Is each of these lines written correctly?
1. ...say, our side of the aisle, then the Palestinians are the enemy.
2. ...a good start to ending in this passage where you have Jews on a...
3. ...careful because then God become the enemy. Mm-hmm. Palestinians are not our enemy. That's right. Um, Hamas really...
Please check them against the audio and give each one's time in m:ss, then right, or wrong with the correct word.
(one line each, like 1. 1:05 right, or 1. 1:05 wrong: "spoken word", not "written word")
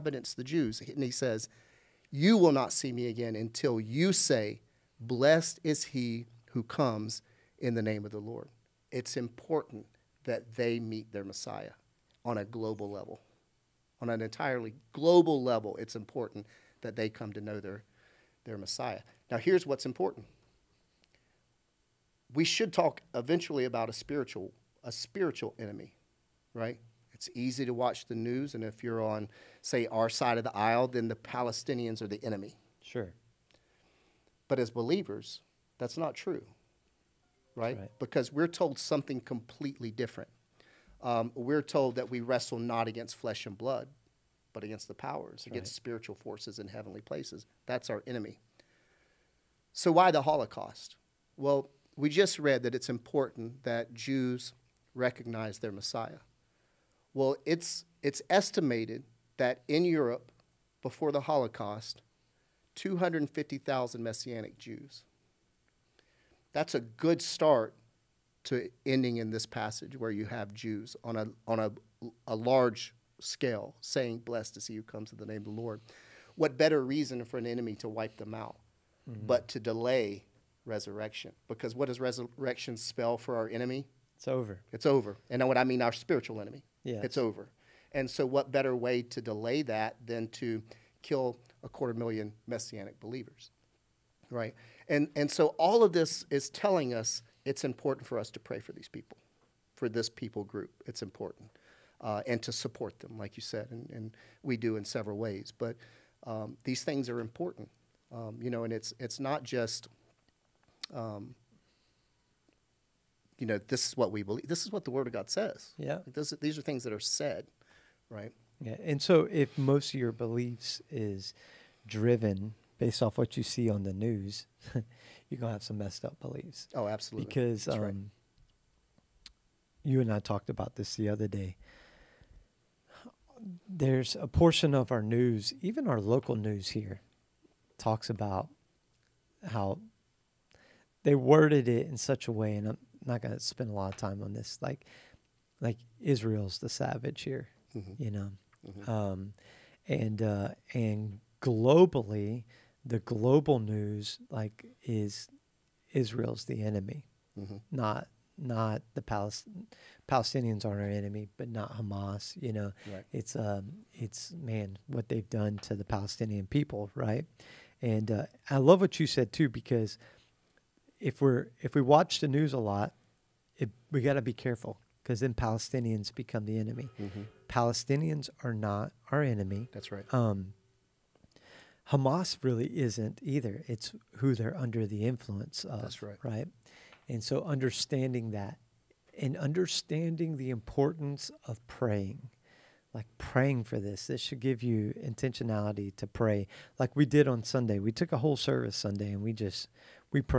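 1. 0:29 right
2. 1:06 right
3. 2:54 wrong: "Palestinians", not "God".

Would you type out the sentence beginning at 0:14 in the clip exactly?
On an entirely global level, it's important that they come to know their, their Messiah.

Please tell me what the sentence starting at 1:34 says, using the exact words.
And, and so all of this is telling us it's important for us to pray for these people, for this people group.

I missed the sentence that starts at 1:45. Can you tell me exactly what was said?
But um, these things are important, um, you know, and it's it's not just, um, you know, this is what we believe.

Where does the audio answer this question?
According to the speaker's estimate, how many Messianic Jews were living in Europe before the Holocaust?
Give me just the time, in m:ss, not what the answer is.
1:02.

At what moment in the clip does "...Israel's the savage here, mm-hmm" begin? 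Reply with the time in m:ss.
2:26.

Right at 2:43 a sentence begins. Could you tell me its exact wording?
it's um, it's man what they've done to the Palestinian people, right?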